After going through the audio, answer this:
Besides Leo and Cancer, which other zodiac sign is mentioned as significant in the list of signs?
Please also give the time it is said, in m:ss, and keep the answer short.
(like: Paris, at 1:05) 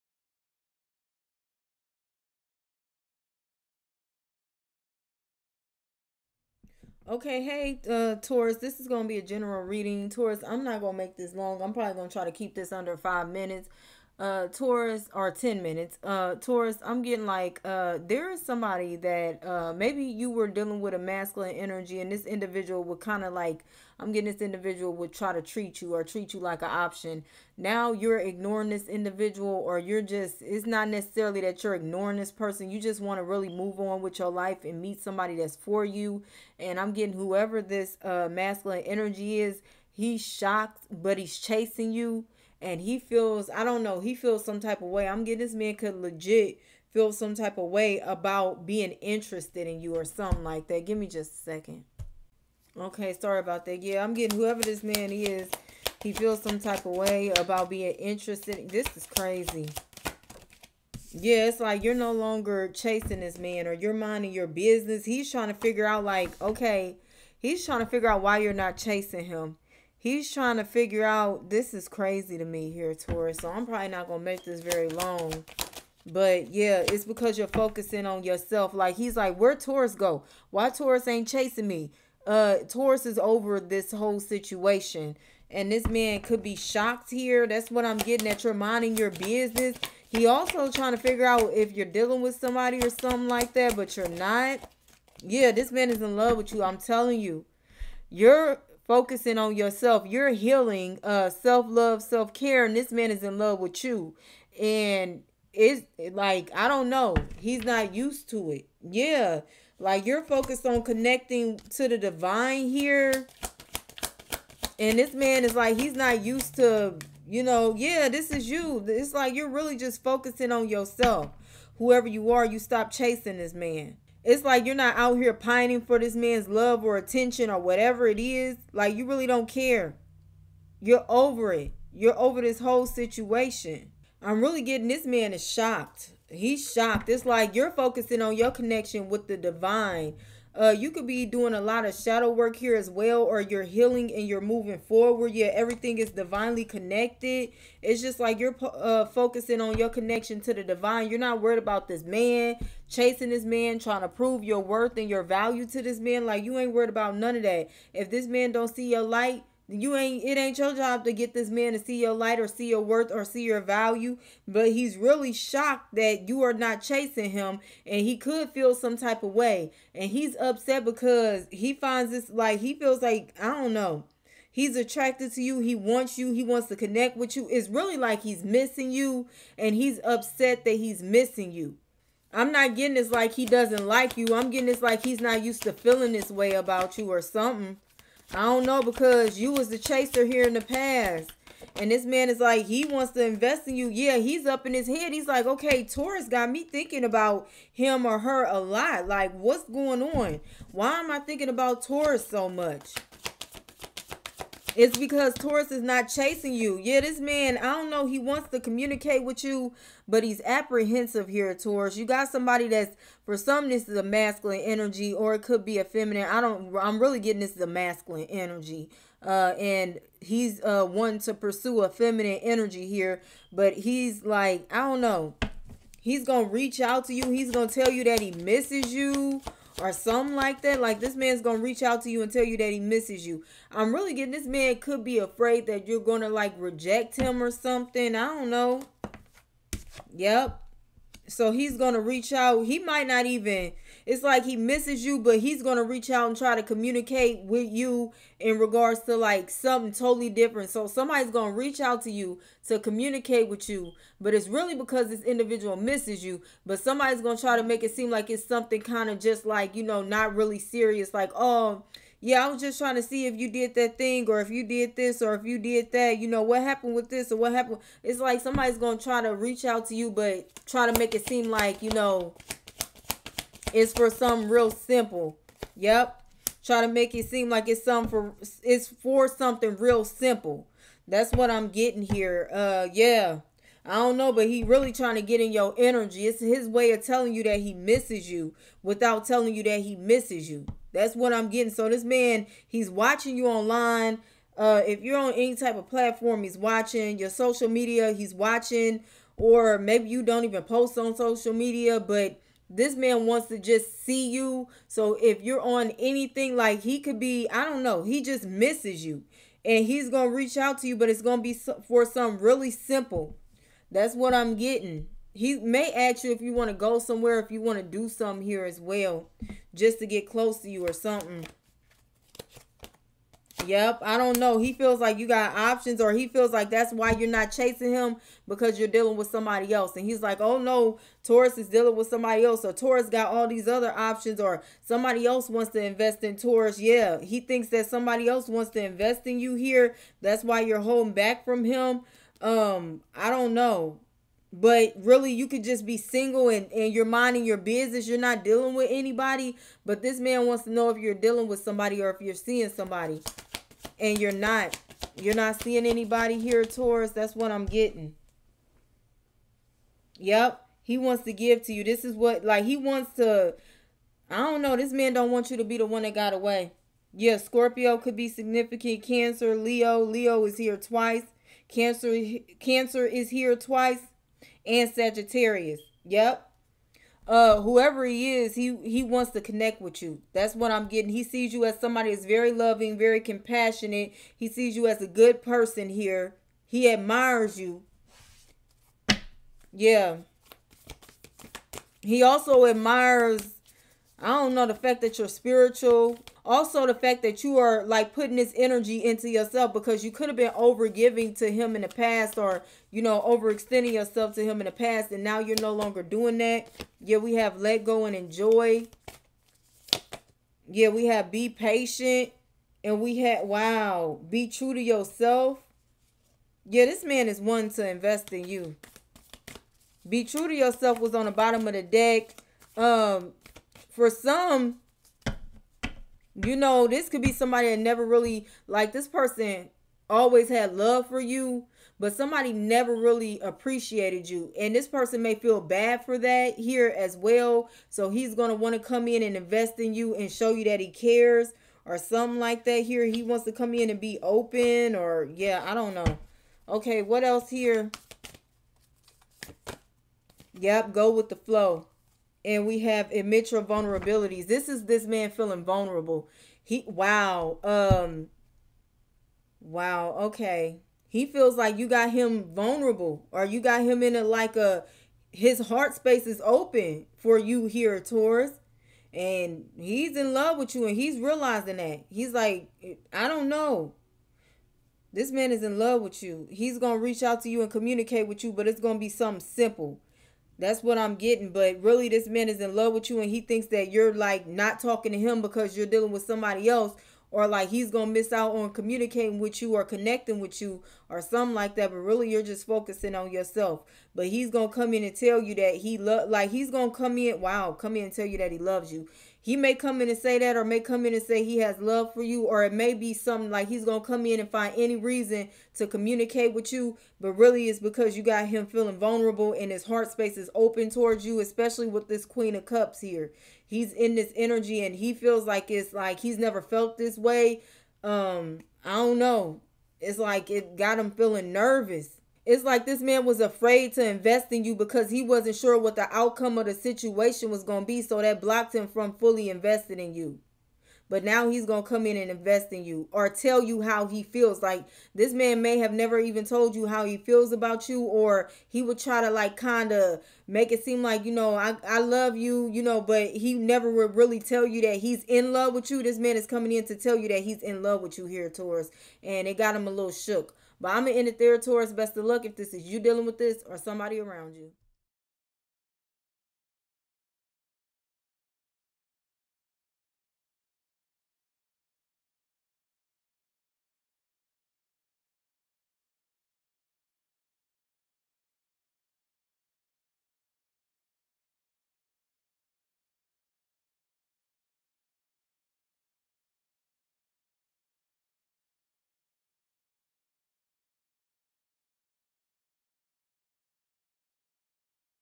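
Sagittarius, at 6:14.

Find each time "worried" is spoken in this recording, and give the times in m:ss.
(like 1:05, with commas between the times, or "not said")
2:31, 2:36.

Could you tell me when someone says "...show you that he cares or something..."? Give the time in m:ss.
7:20.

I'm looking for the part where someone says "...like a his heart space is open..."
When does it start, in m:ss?
7:44.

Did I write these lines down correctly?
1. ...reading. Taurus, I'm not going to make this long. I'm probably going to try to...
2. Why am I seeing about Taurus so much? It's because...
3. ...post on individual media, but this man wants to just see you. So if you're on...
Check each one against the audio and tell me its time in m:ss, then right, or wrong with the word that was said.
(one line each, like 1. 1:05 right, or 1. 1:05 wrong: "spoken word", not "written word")
1. 0:09 right
2. 3:20 wrong: "thinking", not "seeing"
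3. 5:00 wrong: "social", not "individual".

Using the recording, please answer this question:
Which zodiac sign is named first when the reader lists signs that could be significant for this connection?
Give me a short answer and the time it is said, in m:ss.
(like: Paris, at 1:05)
Scorpio, at 6:07.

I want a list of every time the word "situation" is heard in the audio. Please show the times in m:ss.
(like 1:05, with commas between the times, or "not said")
1:24, 2:12, 8:46.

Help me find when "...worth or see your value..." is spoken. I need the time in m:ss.
2:42.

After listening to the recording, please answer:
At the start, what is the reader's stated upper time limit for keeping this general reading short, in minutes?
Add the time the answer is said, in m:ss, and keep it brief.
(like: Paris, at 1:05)
10 minutes, at 0:15.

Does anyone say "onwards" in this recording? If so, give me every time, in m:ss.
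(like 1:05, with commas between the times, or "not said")
not said.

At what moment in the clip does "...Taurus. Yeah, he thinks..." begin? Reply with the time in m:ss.
5:36.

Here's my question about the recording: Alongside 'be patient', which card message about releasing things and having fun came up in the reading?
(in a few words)
let go and enjoy.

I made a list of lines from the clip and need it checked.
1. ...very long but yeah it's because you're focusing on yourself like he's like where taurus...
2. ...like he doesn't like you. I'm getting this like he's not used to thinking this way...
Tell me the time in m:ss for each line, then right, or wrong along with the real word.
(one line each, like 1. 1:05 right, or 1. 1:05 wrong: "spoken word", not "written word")
1. 1:14 right
2. 3:03 wrong: "feeling", not "thinking".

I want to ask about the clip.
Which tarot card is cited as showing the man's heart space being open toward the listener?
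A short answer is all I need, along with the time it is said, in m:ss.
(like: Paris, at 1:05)
Queen of Cups, at 8:32.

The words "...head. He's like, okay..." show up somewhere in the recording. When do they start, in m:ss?
3:14.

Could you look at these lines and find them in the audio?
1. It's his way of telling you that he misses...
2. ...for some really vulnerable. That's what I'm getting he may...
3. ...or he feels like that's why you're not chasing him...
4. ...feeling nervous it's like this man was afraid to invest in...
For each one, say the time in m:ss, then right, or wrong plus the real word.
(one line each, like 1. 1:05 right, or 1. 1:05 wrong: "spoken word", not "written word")
1. 4:46 right
2. 5:11 wrong: "simple", not "vulnerable"
3. 5:26 right
4. 8:41 right.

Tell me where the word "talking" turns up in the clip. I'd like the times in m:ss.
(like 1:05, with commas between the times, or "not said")
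8:04.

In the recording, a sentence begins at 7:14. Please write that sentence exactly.
And this person may feel bad for that here as well.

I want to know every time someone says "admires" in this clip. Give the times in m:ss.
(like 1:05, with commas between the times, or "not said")
6:26, 6:32.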